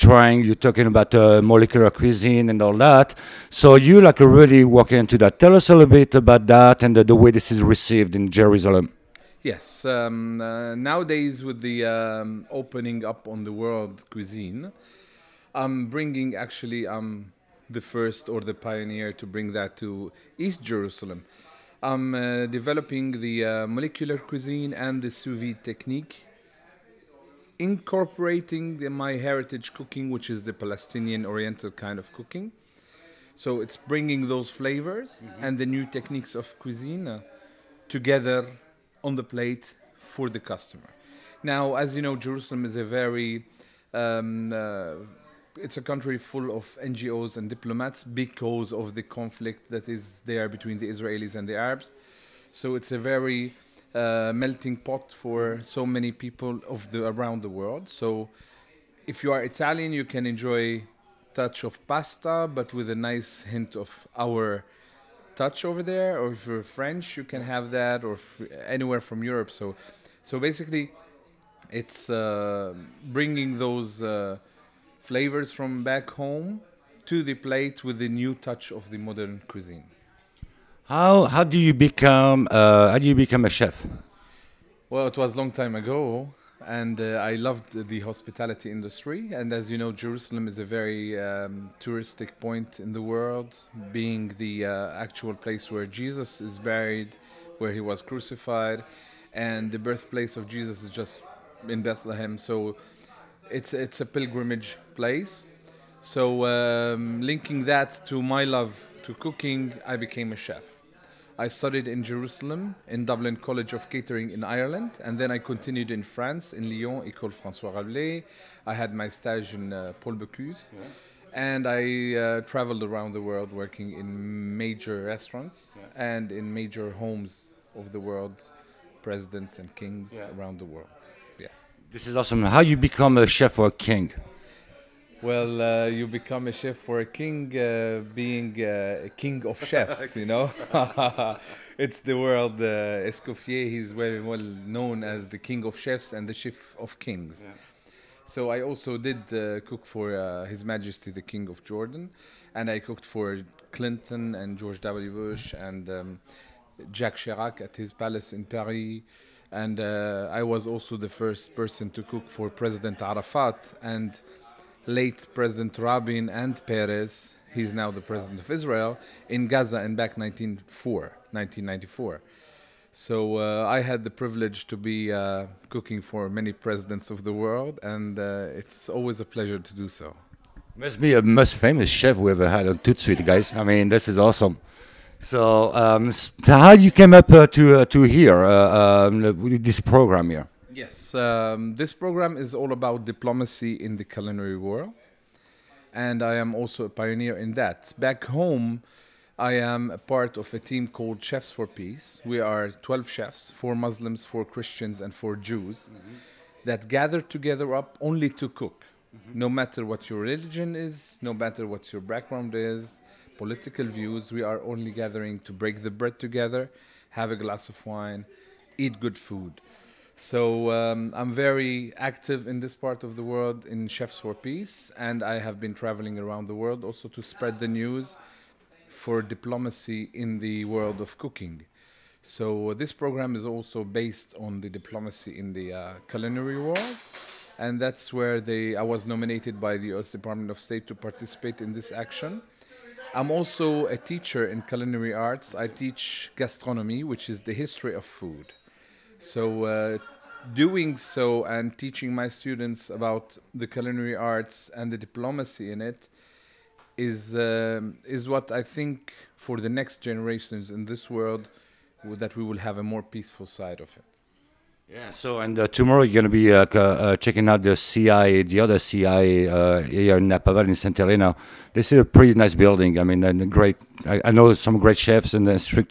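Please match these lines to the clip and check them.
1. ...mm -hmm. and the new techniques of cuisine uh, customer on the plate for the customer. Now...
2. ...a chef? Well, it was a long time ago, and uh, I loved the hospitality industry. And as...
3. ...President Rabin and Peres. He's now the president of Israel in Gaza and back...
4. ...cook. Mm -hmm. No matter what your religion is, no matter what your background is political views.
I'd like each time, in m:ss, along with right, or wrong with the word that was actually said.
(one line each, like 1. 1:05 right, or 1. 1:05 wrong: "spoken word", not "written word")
1. 0:35 wrong: "together", not "customer"
2. 1:23 right
3. 2:45 right
4. 3:28 right.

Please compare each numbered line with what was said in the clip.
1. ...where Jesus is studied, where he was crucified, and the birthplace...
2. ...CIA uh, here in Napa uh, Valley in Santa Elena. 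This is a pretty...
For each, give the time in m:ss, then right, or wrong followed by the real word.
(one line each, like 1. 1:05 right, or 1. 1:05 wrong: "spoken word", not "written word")
1. 1:35 wrong: "buried", not "studied"
2. 4:28 right.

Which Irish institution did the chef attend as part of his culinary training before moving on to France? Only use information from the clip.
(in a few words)
Dublin College of Catering.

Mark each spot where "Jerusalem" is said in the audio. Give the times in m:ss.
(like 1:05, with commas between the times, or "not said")
0:08, 0:20, 0:42, 1:29, 1:52.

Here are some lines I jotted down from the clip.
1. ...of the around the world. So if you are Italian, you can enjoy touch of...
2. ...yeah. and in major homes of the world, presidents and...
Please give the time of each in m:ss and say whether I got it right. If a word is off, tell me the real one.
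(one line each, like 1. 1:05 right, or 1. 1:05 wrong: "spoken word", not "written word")
1. 0:56 right
2. 2:05 right.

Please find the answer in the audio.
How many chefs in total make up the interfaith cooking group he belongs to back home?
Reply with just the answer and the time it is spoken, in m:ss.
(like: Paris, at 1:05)
12, at 3:22.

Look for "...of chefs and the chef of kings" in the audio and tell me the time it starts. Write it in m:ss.
2:25.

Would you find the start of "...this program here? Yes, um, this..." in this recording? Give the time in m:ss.
3:09.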